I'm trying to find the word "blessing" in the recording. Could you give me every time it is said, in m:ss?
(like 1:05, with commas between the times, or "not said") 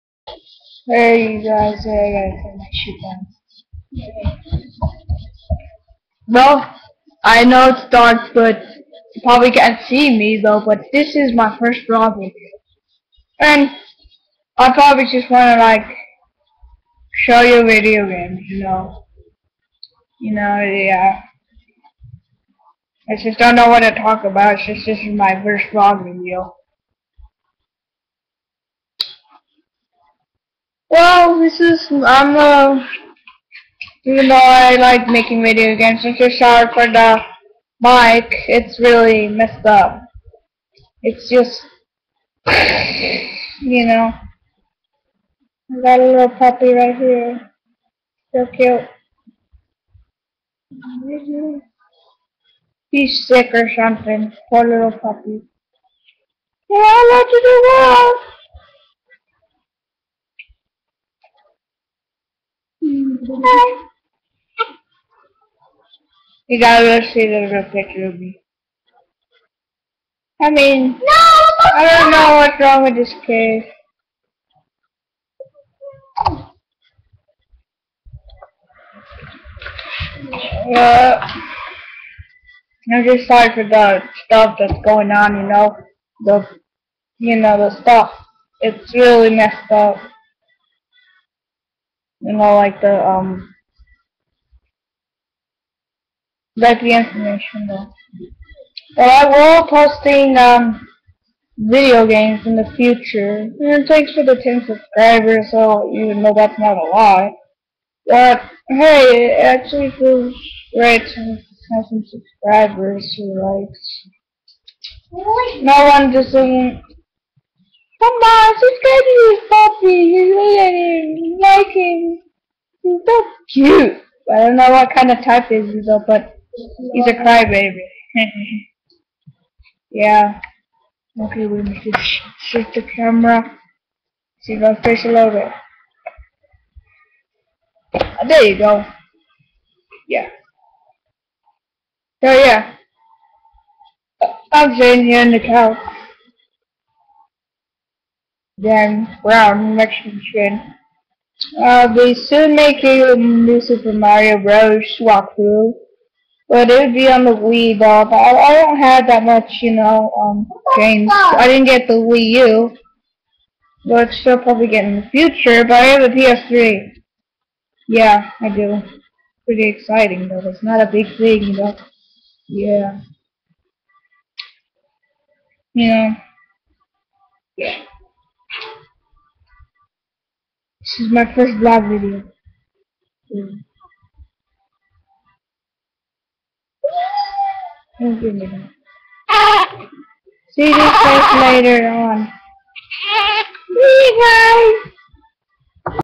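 not said.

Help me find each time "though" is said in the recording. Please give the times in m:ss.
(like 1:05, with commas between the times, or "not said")
0:10, 0:34, 1:37, 2:05, 2:37, 2:50.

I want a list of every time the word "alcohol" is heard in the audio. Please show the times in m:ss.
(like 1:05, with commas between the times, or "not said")
not said.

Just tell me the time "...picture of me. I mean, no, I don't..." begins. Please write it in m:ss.
1:07.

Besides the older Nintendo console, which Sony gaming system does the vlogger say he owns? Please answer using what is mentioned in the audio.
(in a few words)
PS3.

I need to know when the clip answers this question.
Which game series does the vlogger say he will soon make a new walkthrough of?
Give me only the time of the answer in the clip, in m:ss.
2:33.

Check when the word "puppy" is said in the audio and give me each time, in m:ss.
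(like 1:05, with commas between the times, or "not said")
0:46, 0:54, 1:59.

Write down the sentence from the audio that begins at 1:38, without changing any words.
Alright, we're posting um video games in the future.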